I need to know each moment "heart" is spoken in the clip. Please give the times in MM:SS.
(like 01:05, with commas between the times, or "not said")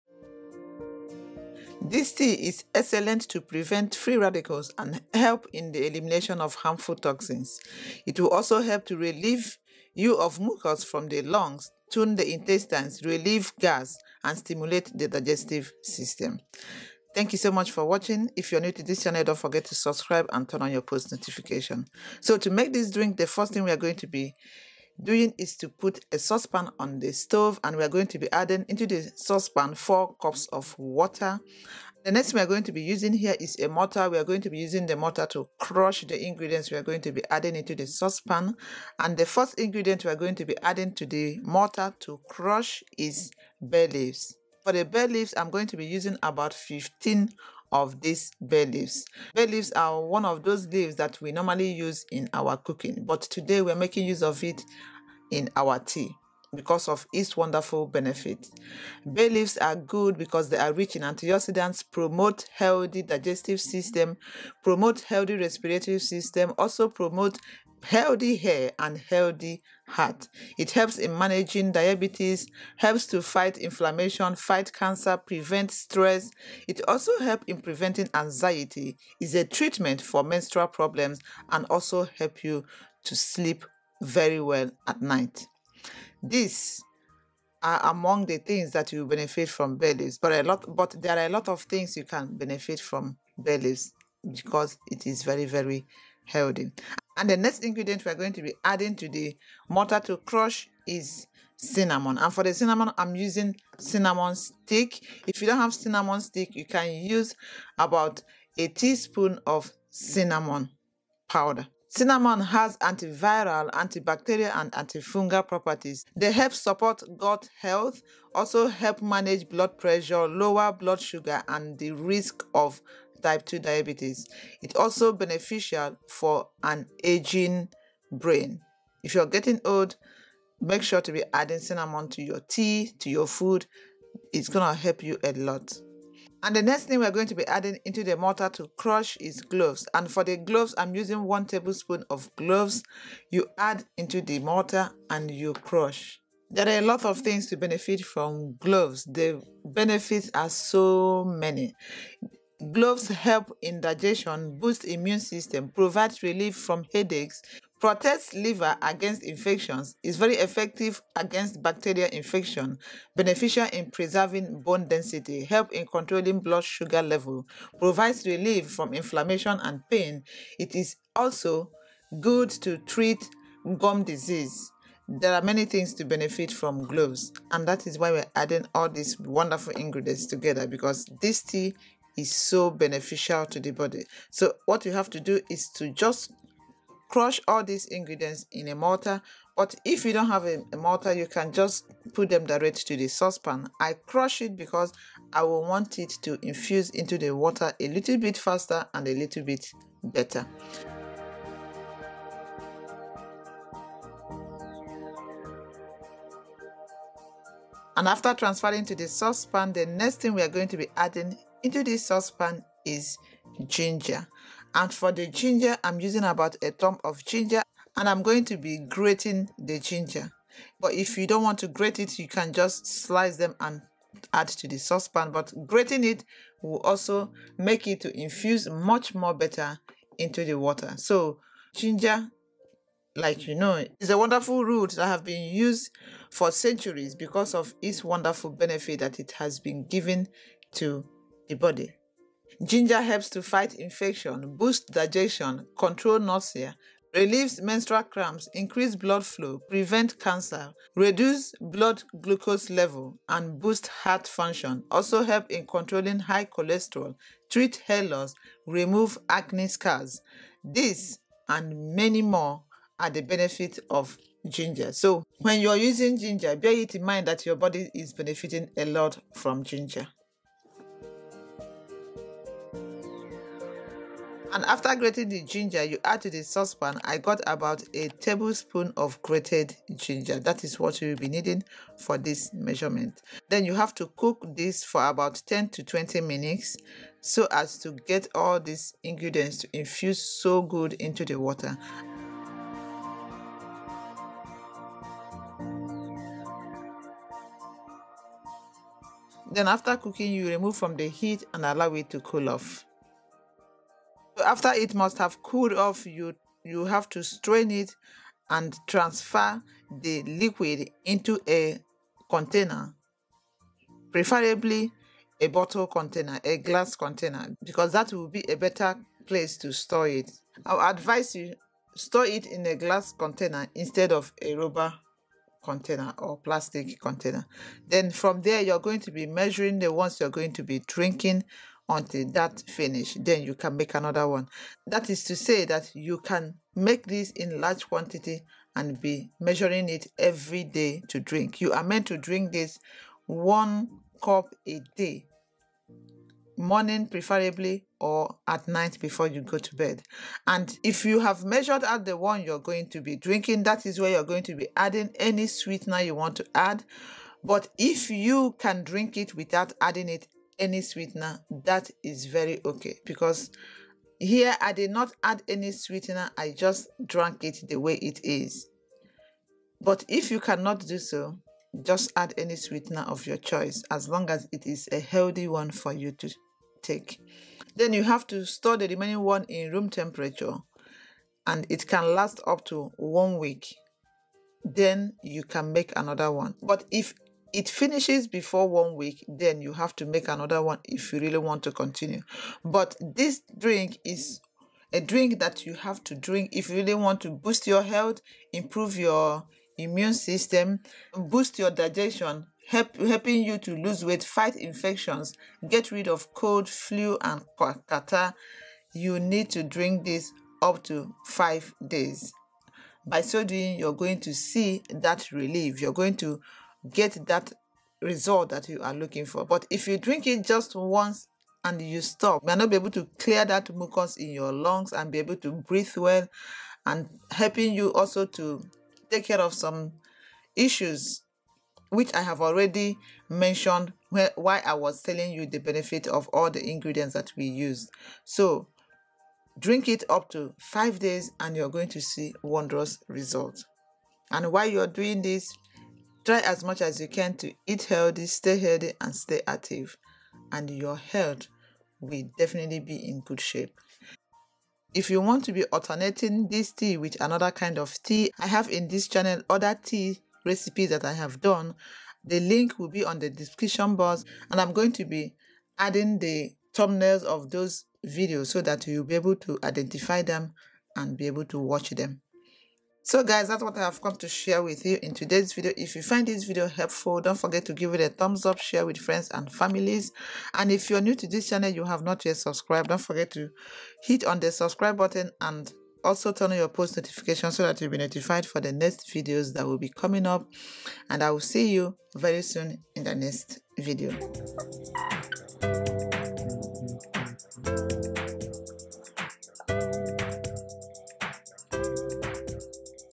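01:09, 04:13.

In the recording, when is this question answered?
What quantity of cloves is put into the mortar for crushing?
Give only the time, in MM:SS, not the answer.
02:21.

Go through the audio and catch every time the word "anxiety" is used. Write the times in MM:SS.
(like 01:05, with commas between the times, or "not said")
01:18.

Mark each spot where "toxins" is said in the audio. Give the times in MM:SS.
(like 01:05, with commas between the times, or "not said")
00:06.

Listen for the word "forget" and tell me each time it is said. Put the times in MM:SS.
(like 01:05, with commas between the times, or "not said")
00:19, 07:57, 08:02.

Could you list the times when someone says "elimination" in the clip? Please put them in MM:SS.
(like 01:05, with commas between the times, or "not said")
00:05.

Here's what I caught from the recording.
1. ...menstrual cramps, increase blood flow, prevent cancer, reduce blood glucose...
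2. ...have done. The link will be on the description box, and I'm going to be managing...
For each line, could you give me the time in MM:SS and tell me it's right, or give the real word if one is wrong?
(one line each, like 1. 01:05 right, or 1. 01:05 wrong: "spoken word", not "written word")
1. 04:07 right
2. 07:41 wrong: "adding", not "managing".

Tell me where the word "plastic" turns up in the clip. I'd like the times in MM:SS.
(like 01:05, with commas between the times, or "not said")
05:26.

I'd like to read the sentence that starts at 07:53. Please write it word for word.
So guys, that's what I have come to share with you in today's video.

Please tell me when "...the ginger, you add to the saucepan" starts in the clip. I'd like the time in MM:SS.
04:35.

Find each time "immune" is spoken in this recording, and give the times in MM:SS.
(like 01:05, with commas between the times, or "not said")
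02:34, 06:39.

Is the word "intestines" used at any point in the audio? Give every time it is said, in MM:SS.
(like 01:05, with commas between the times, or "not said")
00:12.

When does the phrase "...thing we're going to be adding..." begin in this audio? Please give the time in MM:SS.
02:16.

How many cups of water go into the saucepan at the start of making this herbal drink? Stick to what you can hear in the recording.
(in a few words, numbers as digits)
4 cups.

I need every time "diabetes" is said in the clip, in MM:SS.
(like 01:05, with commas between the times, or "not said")
01:11, 02:03.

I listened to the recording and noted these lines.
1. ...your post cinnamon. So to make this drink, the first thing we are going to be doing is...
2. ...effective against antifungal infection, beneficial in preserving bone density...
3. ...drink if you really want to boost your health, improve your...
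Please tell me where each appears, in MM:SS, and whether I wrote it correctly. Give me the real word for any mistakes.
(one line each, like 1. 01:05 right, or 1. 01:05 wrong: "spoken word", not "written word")
1. 00:20 wrong: "notification", not "cinnamon"
2. 02:40 wrong: "bacterial", not "antifungal"
3. 06:36 right.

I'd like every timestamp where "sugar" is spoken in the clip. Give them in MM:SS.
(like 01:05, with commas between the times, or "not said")
02:00, 02:46.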